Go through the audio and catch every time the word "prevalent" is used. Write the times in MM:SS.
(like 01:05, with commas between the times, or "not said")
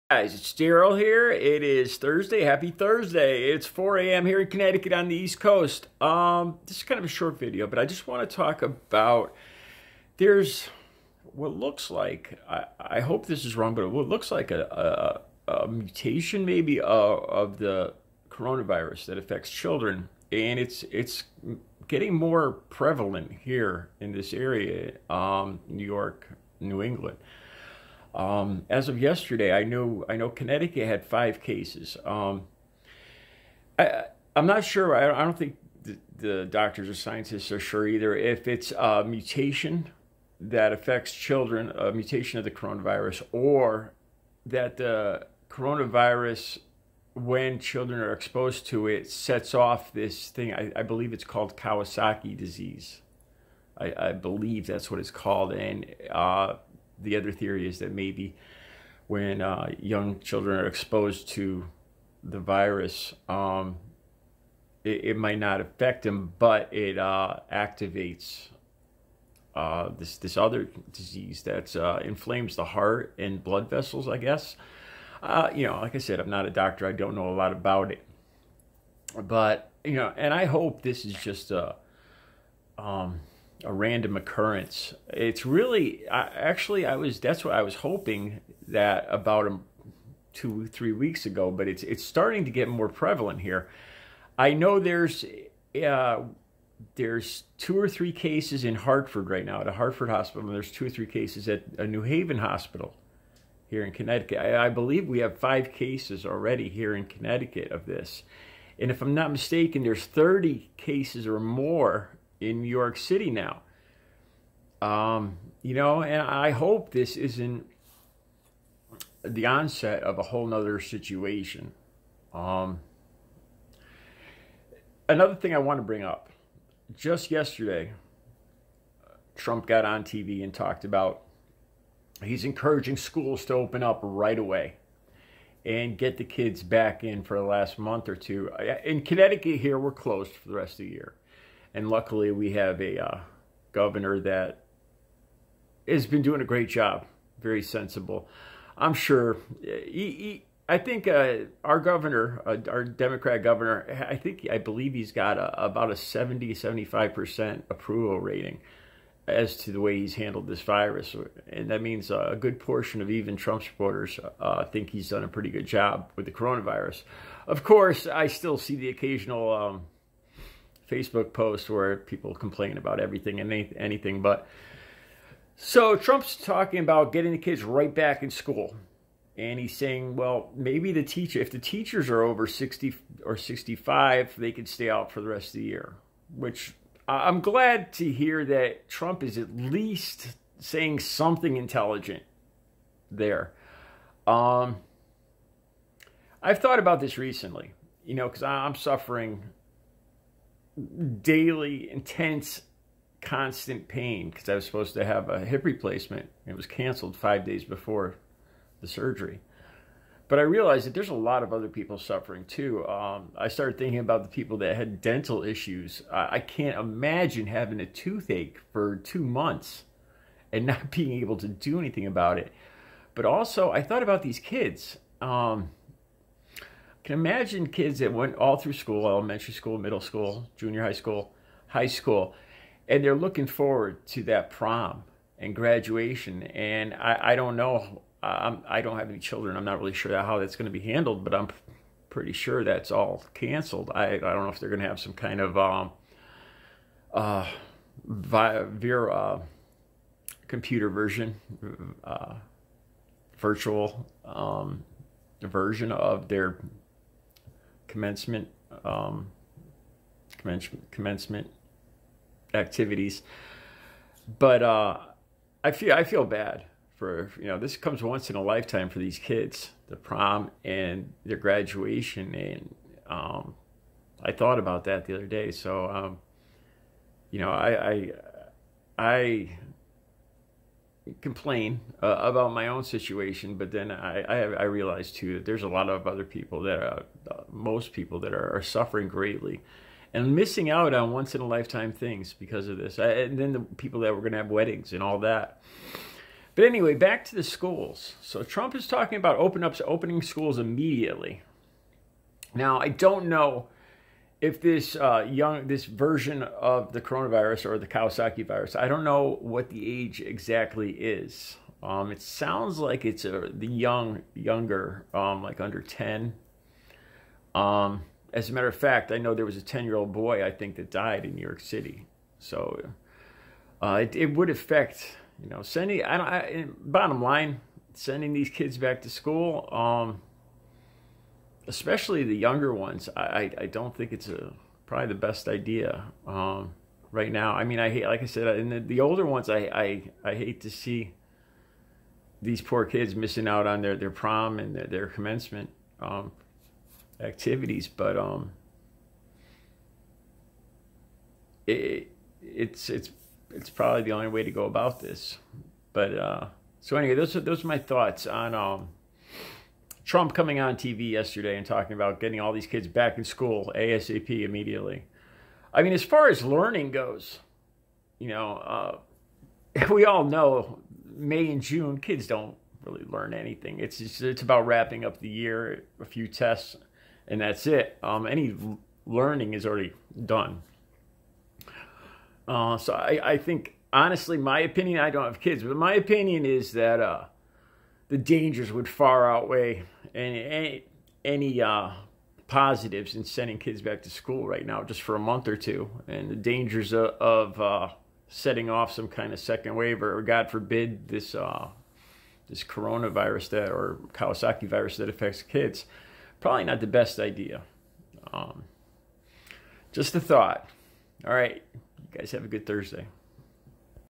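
00:22, 01:32.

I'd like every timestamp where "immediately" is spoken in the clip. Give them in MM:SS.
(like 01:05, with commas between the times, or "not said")
05:00, 06:04.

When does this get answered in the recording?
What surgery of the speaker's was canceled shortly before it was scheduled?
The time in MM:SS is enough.
03:25.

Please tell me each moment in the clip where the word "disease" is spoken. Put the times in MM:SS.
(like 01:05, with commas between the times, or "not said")
00:52, 01:10.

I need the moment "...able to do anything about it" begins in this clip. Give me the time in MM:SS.
03:41.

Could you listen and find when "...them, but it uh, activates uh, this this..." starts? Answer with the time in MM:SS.
01:06.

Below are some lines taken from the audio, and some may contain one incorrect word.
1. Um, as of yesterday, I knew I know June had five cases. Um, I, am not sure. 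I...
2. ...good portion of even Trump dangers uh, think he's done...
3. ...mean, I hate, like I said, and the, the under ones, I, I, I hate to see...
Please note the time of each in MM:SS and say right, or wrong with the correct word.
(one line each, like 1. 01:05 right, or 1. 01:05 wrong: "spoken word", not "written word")
1. 00:28 wrong: "Connecticut", not "June"
2. 02:42 wrong: "supporters", not "dangers"
3. 05:37 wrong: "older", not "under".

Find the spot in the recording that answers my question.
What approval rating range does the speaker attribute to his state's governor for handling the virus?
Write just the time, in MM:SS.
02:35.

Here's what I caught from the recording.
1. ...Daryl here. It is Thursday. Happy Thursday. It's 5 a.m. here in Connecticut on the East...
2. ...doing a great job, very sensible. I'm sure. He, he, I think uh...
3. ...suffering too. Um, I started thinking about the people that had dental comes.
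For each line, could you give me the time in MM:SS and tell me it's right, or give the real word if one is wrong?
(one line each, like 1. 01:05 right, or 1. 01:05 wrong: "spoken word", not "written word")
1. 00:00 wrong: "4", not "5"
2. 02:26 right
3. 03:31 wrong: "issues", not "comes".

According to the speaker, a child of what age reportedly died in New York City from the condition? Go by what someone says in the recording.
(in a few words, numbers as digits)
10.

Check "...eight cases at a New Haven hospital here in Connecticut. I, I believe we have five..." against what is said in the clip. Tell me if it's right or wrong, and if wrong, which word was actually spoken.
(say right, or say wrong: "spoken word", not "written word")
wrong: "three", not "eight".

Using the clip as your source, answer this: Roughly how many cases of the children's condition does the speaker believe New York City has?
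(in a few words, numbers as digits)
30.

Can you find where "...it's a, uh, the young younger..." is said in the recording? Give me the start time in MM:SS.
05:13.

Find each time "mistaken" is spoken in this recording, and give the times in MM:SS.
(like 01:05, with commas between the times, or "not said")
01:49.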